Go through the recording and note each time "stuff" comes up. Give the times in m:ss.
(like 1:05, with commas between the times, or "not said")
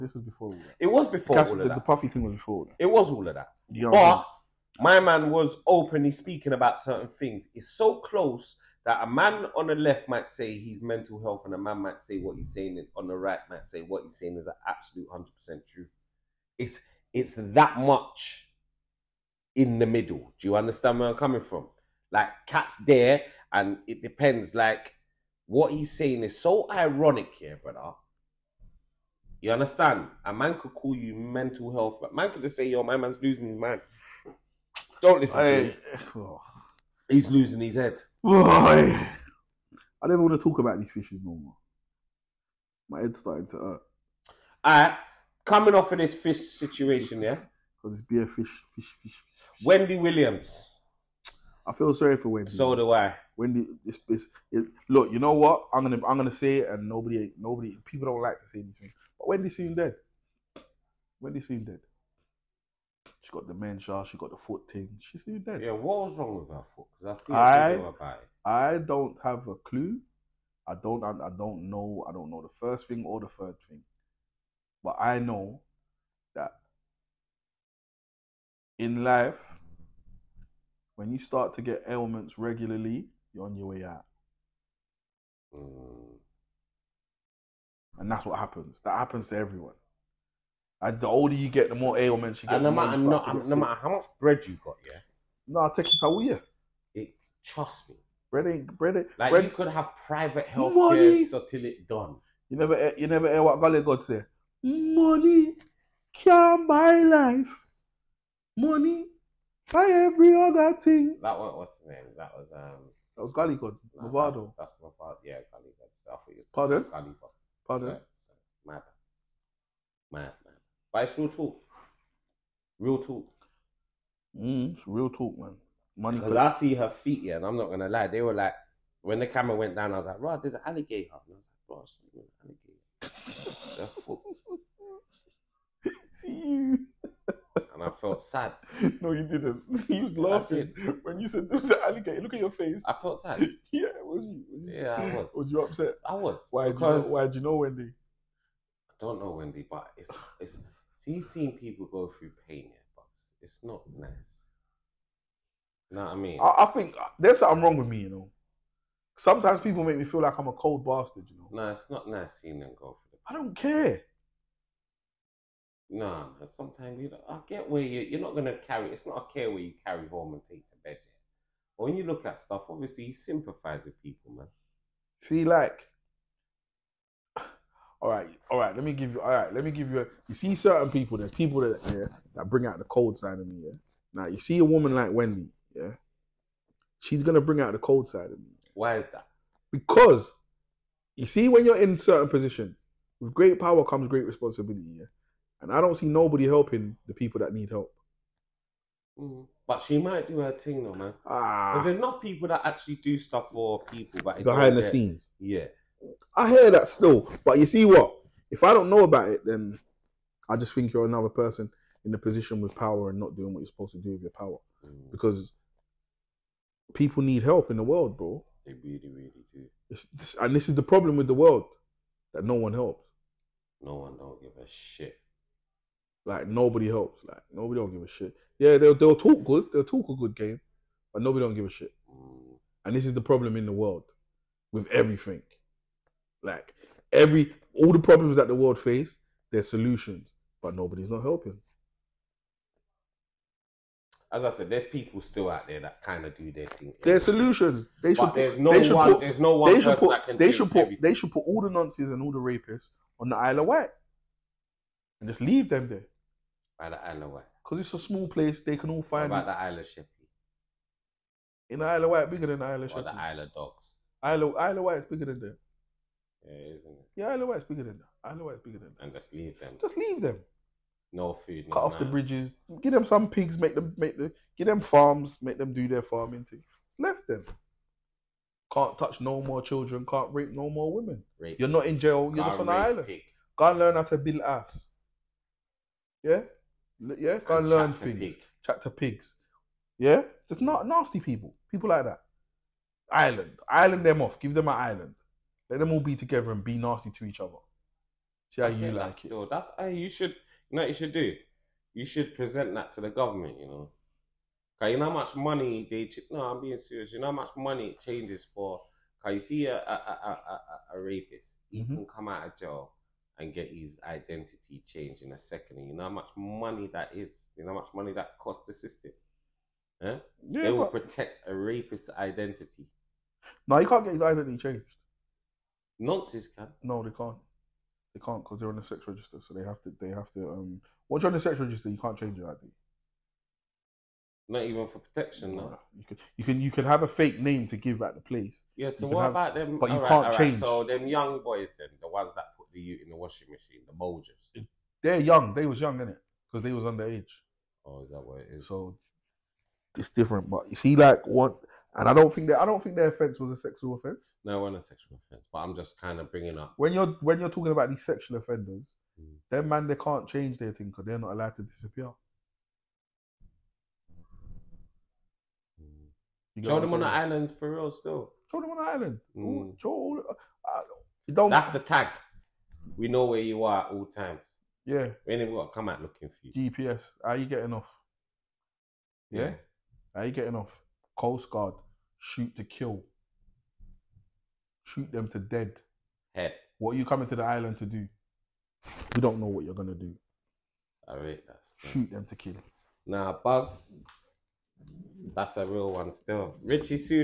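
2:52, 3:23.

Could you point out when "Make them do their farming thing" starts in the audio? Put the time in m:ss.
4:35.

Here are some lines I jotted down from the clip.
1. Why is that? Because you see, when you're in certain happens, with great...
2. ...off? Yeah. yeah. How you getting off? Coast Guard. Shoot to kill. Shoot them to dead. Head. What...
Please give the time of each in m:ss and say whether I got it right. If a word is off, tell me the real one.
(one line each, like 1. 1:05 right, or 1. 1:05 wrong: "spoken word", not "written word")
1. 3:08 wrong: "positions", not "happens"
2. 6:17 right.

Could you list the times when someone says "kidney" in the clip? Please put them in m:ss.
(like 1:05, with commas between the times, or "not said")
not said.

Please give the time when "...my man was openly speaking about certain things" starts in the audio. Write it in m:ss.
0:04.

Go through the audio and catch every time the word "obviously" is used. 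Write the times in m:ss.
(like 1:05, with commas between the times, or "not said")
2:52.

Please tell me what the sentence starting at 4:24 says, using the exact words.
Isle of, Isle of Wight is bigger than them.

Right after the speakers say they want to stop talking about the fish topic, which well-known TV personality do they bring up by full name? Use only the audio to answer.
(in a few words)
Wendy Williams.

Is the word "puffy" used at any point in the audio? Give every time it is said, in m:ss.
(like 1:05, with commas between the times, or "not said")
0:01.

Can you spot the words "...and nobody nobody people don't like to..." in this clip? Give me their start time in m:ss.
0:56.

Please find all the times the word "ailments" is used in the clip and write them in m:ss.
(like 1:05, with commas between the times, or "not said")
1:21, 1:31.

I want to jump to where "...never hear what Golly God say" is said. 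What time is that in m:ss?
1:43.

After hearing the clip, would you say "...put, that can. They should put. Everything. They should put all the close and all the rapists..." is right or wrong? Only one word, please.
wrong.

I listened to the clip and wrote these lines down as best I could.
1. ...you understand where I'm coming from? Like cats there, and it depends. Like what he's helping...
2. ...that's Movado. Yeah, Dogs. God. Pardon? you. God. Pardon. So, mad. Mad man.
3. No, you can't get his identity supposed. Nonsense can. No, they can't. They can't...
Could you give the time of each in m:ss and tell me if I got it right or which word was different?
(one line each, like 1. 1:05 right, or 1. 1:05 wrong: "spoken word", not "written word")
1. 0:20 wrong: "saying", not "helping"
2. 1:54 wrong: "Gallicot", not "Dogs"
3. 5:23 wrong: "changed", not "supposed".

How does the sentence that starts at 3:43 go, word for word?
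No one don't give a shit.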